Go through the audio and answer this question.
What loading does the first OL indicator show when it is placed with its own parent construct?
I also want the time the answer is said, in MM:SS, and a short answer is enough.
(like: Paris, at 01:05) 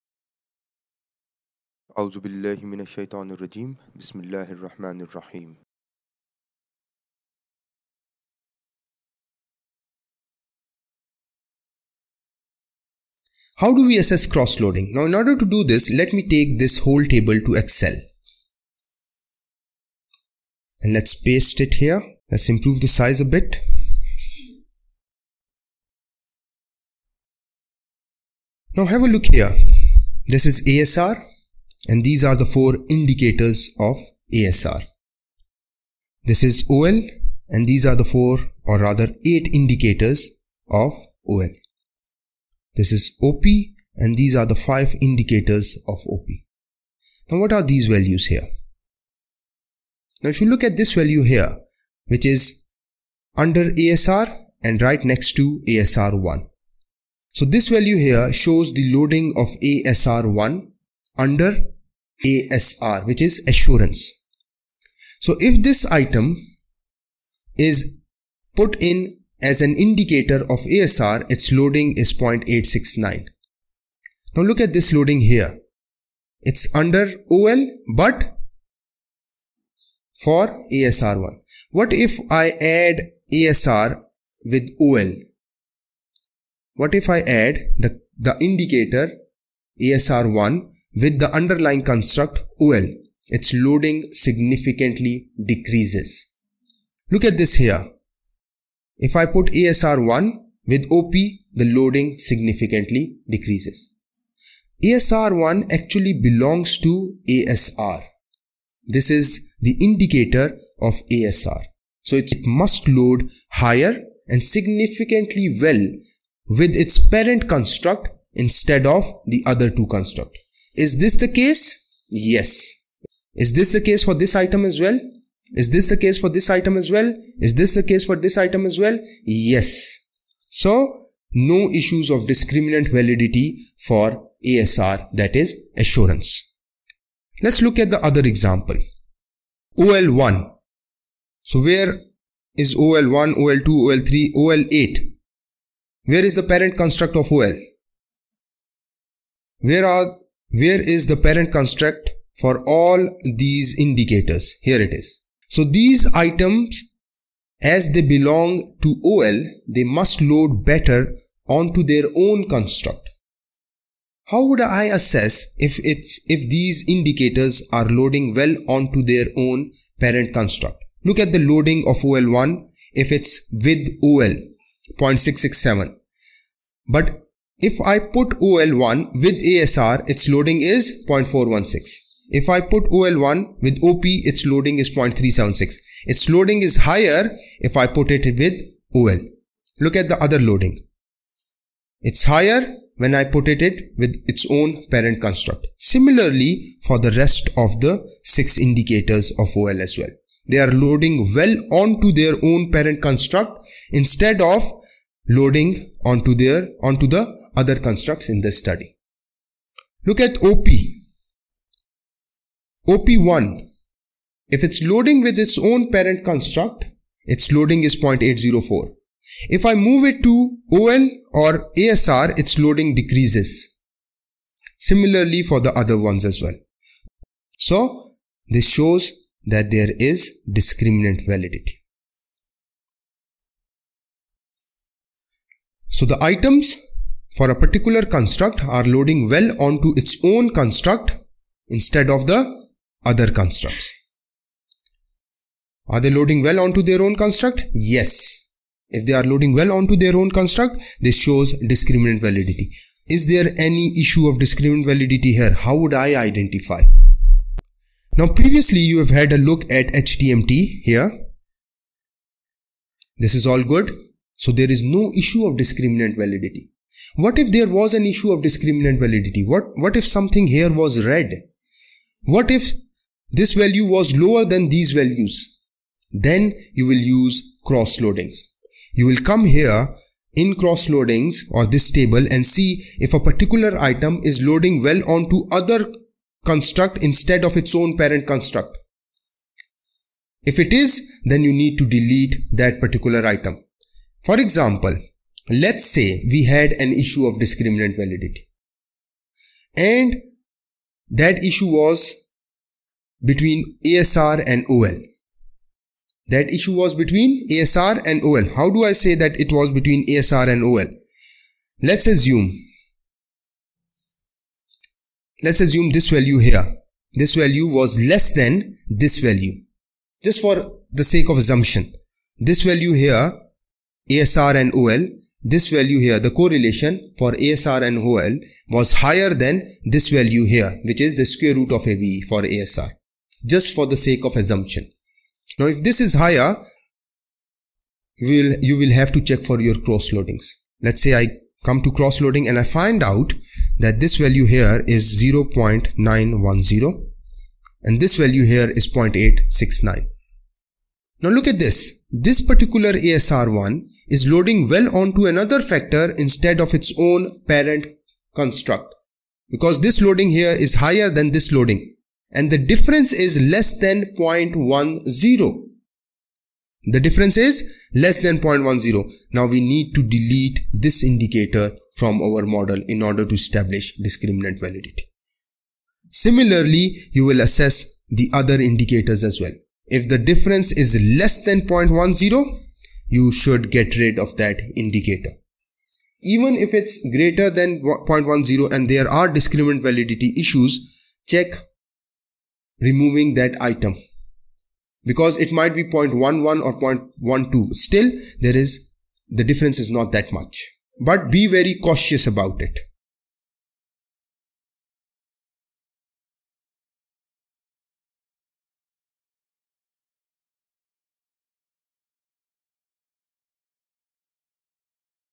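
0.667, at 02:54.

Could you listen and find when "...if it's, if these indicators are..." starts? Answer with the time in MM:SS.
02:45.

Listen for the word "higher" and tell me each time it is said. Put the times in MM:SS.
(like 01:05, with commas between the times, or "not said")
01:53, 03:06, 03:12, 05:29, 05:36, 06:00.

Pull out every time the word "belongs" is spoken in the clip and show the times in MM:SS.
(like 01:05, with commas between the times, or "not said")
01:46, 02:38.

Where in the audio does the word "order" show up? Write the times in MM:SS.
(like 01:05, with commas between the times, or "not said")
00:15, 06:13.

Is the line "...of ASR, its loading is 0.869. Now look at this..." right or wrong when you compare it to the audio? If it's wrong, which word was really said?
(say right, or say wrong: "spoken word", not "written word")
right.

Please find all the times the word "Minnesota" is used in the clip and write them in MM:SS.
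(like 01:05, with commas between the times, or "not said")
not said.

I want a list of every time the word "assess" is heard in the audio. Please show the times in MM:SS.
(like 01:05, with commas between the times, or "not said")
00:13, 02:44, 06:17.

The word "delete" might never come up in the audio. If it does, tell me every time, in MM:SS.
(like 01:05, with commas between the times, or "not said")
04:51, 06:10.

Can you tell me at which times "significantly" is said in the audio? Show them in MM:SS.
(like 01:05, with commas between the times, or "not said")
01:34, 01:42, 01:54.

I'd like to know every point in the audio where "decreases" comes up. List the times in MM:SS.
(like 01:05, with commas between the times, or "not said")
01:35, 01:43, 03:42.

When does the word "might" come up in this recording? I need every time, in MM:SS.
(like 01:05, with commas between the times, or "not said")
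06:35.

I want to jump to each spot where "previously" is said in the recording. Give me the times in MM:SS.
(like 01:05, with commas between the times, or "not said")
04:18.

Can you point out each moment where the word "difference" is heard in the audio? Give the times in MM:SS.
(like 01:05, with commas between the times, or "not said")
06:02, 06:06, 06:20, 06:39.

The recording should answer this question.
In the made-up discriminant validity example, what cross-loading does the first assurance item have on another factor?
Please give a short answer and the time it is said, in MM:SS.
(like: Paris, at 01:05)
0.910, at 05:45.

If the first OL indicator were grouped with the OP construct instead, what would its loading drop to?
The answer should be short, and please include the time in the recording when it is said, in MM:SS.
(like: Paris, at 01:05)
0.376, at 03:04.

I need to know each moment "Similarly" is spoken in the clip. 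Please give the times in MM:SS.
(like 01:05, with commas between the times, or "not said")
03:15, 03:44, 06:16.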